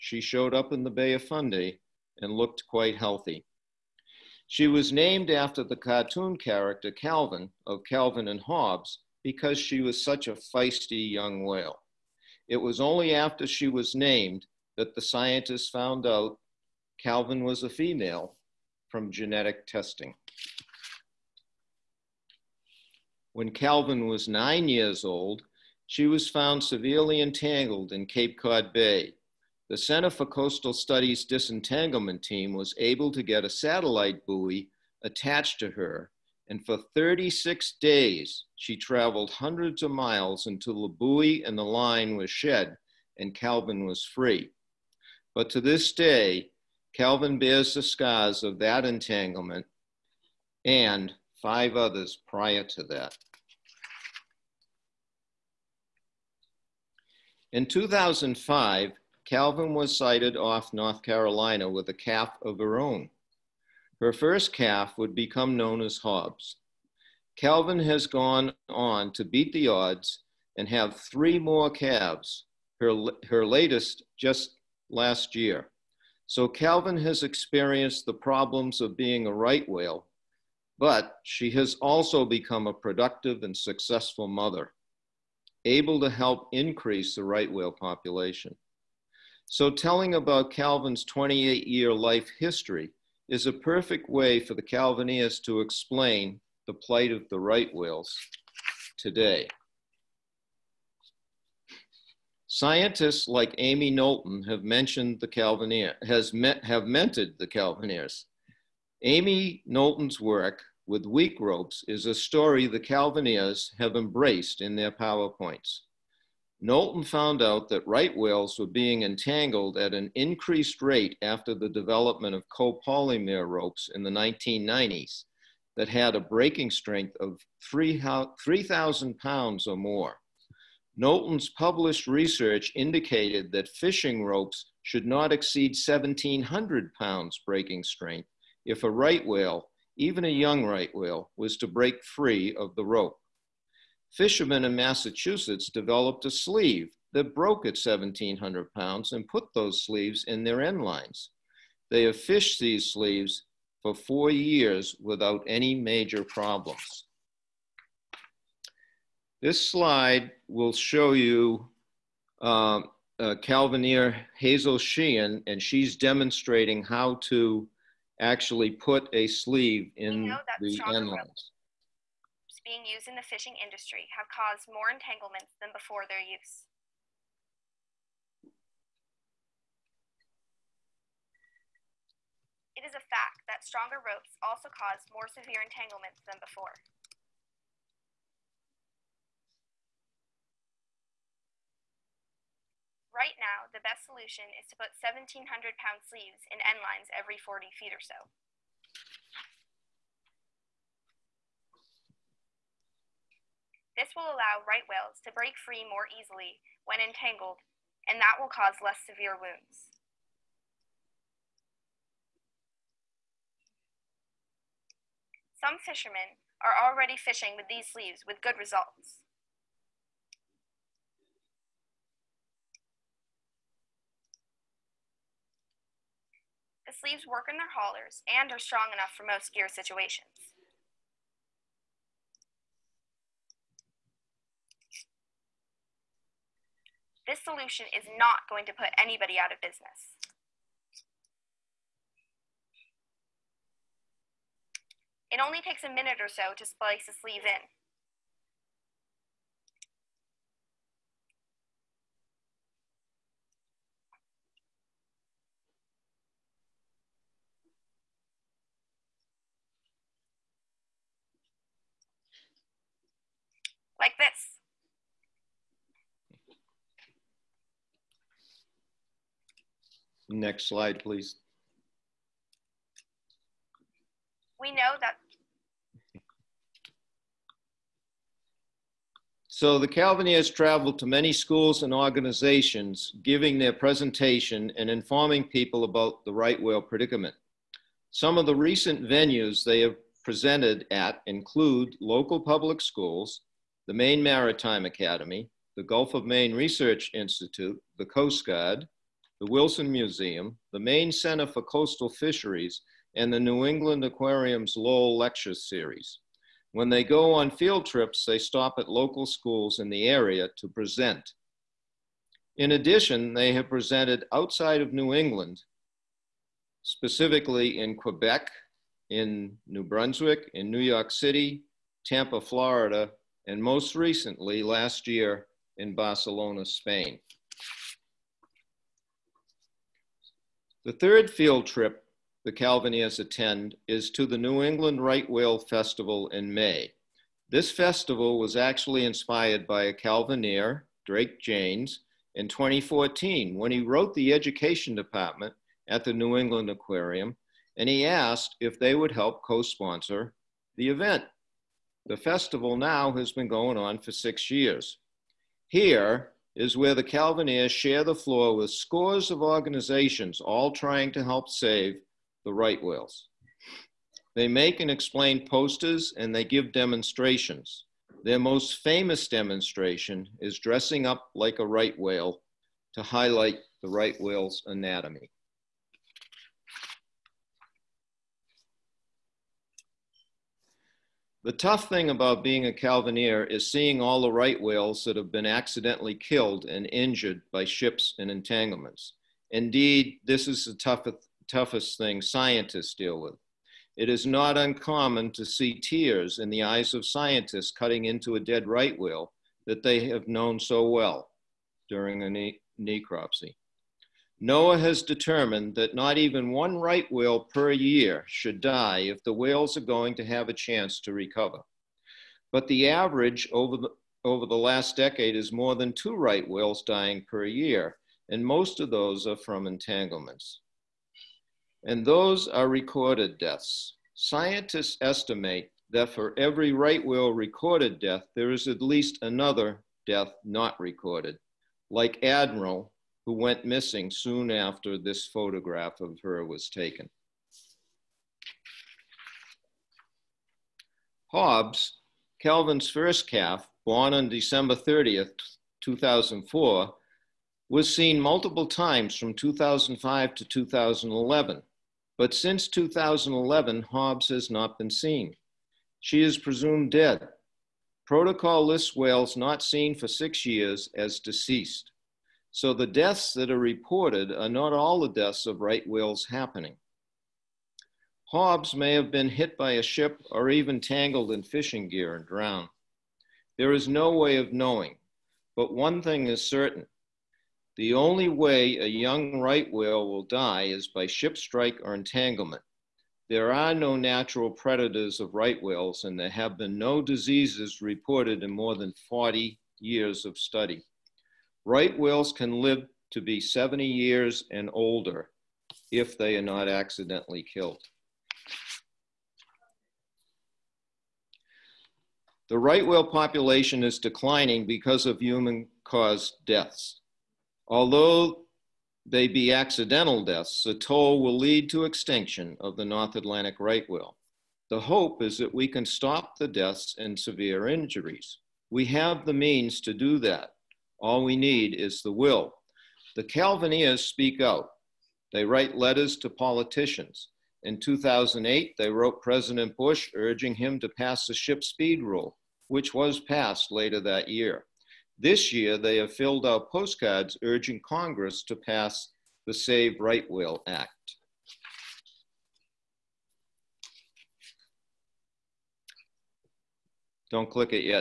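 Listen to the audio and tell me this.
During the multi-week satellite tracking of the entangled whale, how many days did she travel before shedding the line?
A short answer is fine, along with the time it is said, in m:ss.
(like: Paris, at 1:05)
36, at 0:36.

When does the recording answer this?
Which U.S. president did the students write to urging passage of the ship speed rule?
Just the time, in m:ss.
8:49.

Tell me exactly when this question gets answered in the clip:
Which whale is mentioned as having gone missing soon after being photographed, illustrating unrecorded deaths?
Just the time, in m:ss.
7:12.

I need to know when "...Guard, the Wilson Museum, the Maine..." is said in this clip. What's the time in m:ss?
4:58.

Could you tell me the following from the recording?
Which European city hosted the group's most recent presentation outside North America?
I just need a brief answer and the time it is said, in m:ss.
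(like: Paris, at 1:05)
Barcelona, at 5:25.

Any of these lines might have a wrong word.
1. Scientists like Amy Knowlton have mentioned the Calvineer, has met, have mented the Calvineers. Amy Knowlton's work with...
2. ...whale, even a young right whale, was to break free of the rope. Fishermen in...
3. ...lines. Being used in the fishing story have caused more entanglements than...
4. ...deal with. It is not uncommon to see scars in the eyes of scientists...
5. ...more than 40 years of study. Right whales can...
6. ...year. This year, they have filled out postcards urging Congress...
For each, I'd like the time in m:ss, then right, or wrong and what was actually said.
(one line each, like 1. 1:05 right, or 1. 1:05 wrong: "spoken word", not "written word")
1. 1:42 right
2. 2:19 right
3. 2:51 wrong: "industry", not "story"
4. 6:32 wrong: "tears", not "scars"
5. 8:08 right
6. 8:54 right.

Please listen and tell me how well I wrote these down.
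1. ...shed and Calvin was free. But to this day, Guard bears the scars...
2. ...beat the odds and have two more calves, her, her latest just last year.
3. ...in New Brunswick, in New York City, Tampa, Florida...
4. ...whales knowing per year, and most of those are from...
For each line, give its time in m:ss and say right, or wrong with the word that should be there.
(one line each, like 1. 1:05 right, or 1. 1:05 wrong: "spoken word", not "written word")
1. 0:42 wrong: "Calvin", not "Guard"
2. 1:09 wrong: "three", not "two"
3. 5:19 right
4. 6:56 wrong: "dying", not "knowing".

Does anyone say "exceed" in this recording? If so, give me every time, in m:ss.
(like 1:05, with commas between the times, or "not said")
2:15.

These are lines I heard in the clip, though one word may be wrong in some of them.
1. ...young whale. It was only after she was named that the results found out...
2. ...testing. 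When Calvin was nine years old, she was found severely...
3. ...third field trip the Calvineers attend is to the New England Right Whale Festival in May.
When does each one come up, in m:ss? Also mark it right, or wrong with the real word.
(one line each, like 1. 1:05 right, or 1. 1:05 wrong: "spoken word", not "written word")
1. 0:11 wrong: "scientists", not "results"
2. 0:19 right
3. 5:30 right.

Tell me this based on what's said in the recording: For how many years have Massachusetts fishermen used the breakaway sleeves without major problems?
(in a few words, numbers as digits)
4.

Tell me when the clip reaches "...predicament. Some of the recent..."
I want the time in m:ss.
4:46.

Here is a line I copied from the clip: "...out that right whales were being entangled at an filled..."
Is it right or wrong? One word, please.
wrong.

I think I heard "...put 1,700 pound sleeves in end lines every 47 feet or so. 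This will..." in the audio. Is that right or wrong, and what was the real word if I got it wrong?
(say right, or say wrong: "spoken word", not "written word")
wrong: "40", not "47".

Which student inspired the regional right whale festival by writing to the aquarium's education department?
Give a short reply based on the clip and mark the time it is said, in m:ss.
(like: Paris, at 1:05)
Drake James, at 5:41.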